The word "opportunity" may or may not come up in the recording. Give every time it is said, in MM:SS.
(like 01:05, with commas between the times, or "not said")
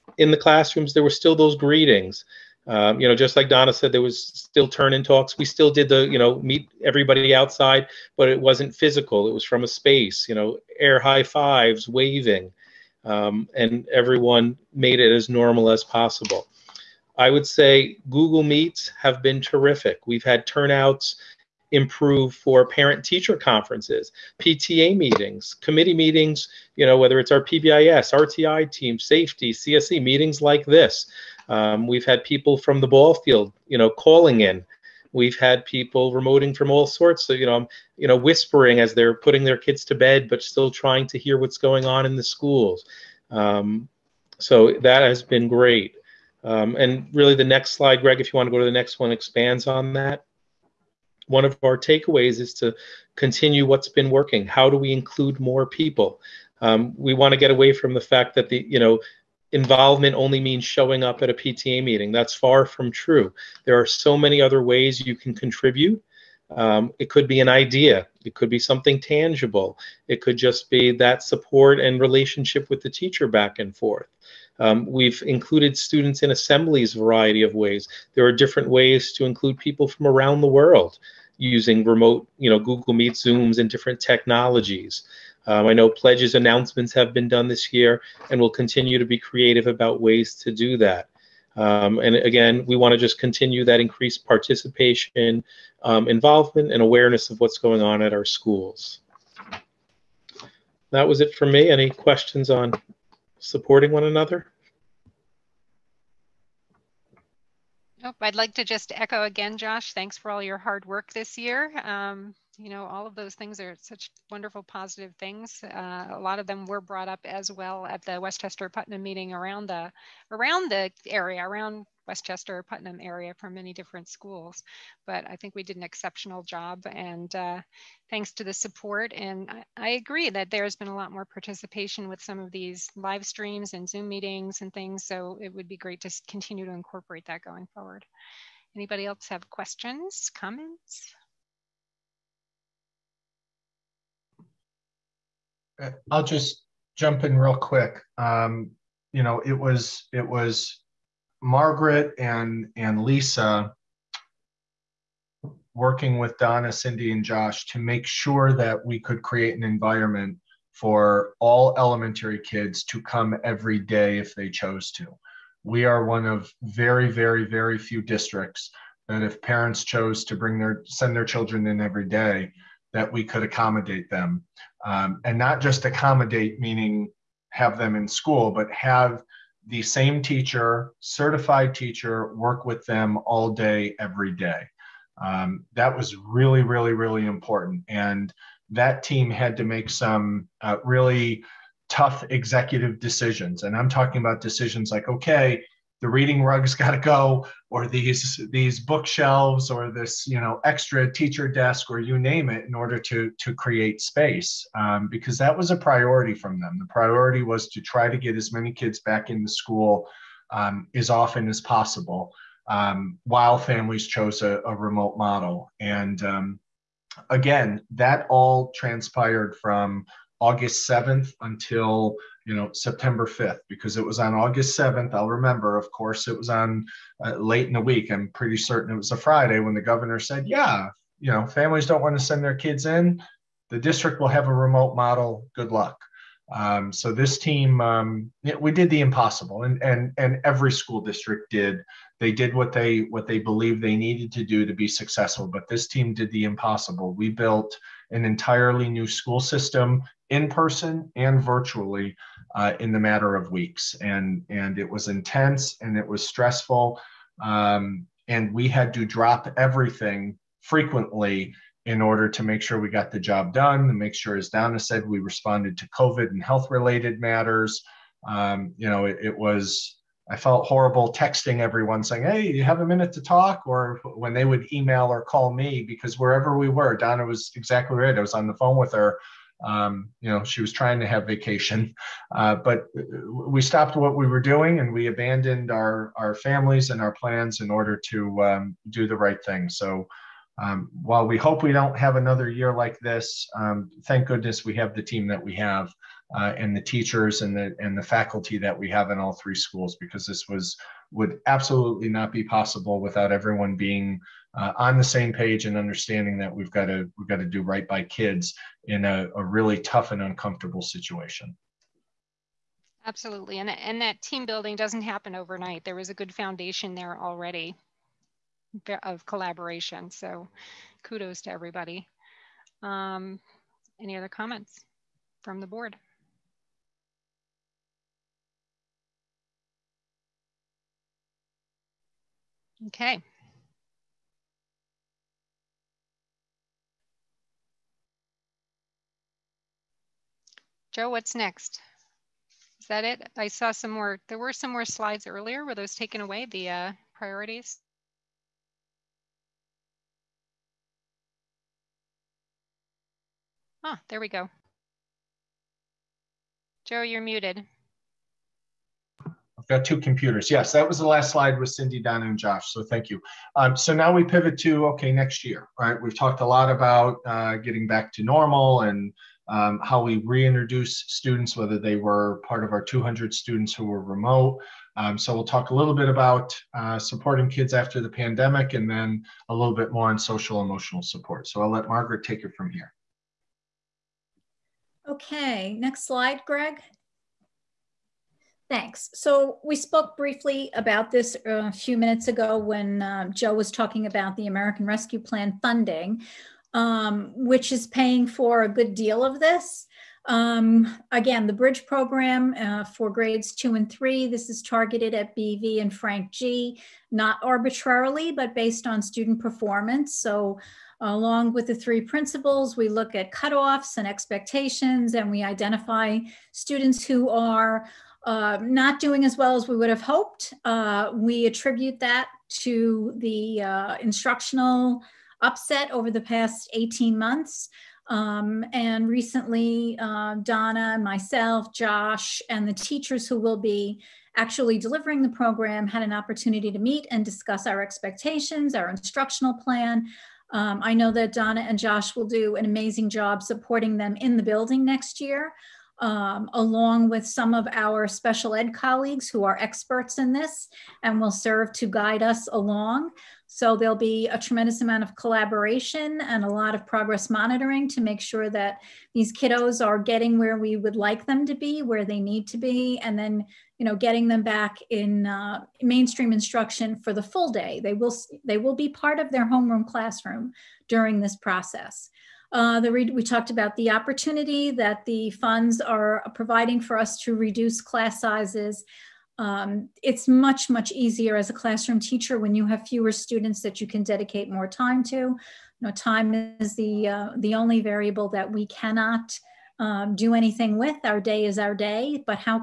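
07:16, 07:53.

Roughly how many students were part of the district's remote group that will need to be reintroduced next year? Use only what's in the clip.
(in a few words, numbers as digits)
200.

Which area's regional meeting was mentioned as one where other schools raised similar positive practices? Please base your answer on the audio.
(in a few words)
Westchester Putnam.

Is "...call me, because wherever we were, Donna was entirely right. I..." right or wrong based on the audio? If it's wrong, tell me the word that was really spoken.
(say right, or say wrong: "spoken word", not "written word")
wrong: "exactly", not "entirely".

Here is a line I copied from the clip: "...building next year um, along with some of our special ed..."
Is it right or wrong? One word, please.
right.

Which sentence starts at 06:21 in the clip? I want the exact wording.
So I'll let Margaret take it from here.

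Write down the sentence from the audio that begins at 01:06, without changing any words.
Um, it could be an idea.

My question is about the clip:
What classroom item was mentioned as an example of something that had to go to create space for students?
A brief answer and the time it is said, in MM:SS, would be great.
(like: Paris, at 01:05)
The reading rug, at 03:16.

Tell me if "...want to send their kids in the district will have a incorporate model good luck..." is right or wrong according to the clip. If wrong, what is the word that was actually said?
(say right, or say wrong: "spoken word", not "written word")
wrong: "remote", not "incorporate".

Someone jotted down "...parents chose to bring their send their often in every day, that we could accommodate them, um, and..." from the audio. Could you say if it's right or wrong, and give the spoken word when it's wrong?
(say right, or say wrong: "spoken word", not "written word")
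wrong: "children", not "often".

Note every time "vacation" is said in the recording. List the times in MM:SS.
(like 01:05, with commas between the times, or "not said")
04:41.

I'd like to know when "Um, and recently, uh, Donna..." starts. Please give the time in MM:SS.
07:08.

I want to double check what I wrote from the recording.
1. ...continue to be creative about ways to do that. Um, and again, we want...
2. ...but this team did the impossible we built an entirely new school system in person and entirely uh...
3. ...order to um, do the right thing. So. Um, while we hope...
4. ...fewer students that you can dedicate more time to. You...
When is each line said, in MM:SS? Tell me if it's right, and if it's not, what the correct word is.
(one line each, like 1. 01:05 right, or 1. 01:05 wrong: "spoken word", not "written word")
1. 01:28 right
2. 04:05 wrong: "virtually", not "entirely"
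3. 04:47 right
4. 08:02 right.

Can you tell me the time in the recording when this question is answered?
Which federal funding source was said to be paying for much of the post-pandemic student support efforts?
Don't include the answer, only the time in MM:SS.
06:34.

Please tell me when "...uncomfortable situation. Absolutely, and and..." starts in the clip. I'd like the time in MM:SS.
05:10.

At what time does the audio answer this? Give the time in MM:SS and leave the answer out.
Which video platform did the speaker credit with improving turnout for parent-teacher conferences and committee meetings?
00:18.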